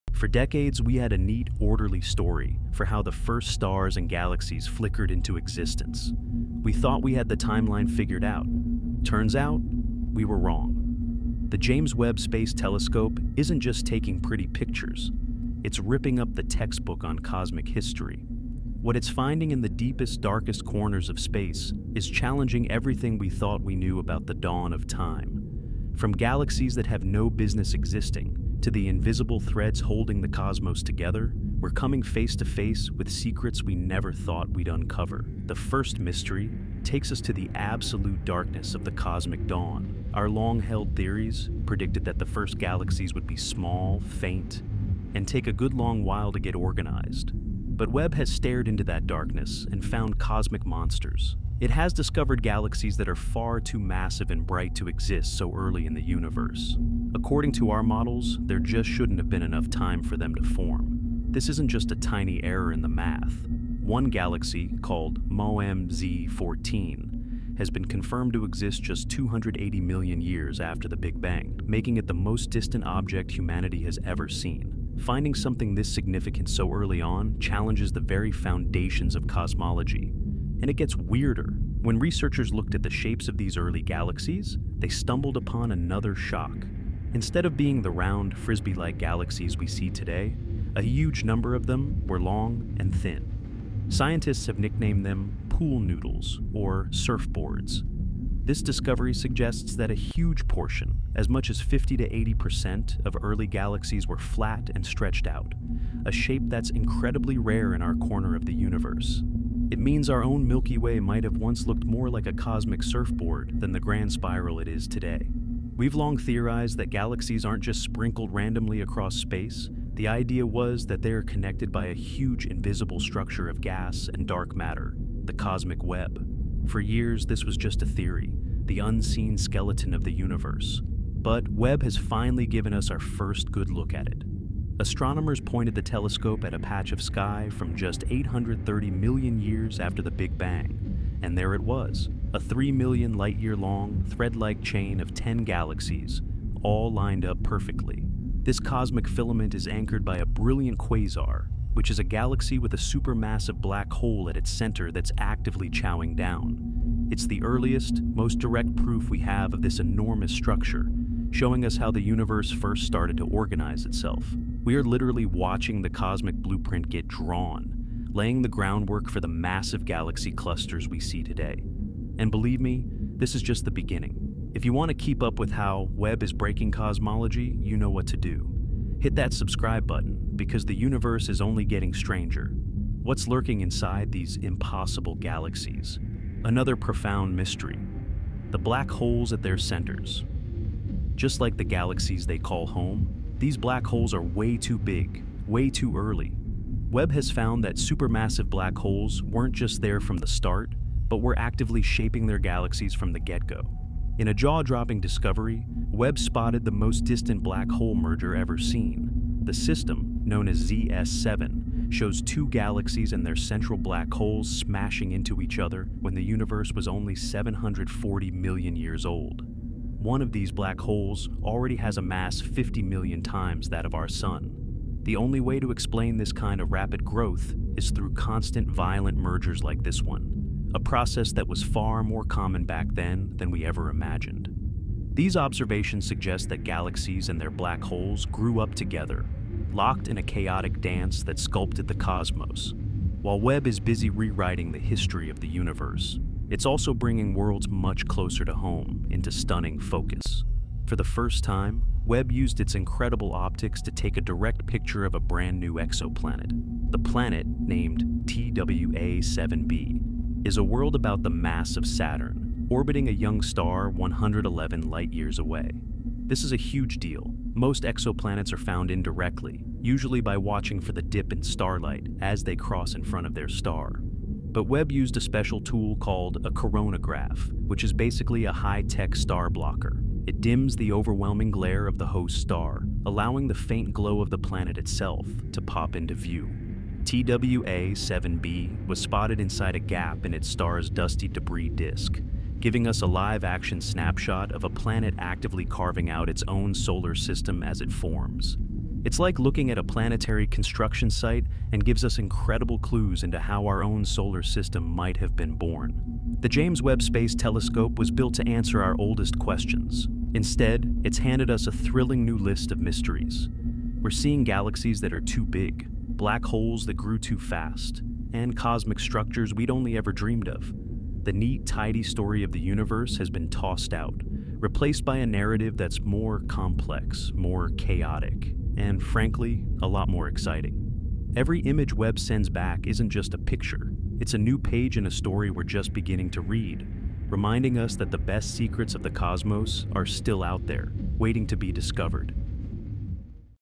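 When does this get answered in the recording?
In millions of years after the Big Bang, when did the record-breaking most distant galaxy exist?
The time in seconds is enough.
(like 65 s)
69 s.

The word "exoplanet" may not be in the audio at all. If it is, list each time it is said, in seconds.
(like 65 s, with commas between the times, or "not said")
255 s, 267 s.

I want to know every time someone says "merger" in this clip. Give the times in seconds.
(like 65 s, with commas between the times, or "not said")
207 s, 229 s.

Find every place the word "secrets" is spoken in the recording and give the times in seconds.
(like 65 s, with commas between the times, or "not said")
33 s, 338 s.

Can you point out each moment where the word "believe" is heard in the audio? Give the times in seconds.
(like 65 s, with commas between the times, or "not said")
172 s.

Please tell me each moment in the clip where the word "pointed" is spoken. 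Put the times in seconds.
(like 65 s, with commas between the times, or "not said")
135 s.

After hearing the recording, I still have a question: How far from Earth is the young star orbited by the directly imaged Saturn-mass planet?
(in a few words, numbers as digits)
111 light-years.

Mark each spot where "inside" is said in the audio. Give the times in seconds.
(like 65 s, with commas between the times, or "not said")
183 s, 289 s.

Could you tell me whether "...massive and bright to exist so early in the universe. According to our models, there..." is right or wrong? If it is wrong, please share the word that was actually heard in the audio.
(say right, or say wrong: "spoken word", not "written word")
right.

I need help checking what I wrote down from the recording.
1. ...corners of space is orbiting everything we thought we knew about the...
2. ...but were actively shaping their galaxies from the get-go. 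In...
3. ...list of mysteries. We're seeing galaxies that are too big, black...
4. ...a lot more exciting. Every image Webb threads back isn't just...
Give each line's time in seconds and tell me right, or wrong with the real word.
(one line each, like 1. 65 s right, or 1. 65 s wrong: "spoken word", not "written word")
1. 20 s wrong: "challenging", not "orbiting"
2. 201 s right
3. 312 s right
4. 329 s wrong: "sends", not "threads".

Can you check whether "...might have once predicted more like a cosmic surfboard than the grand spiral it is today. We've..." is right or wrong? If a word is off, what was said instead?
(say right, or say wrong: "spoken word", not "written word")
wrong: "looked", not "predicted".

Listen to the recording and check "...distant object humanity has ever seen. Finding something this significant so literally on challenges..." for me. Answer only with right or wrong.
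wrong.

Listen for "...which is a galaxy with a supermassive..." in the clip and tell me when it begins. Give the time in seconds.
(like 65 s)
151 s.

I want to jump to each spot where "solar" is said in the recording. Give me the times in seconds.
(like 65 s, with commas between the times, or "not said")
296 s, 304 s.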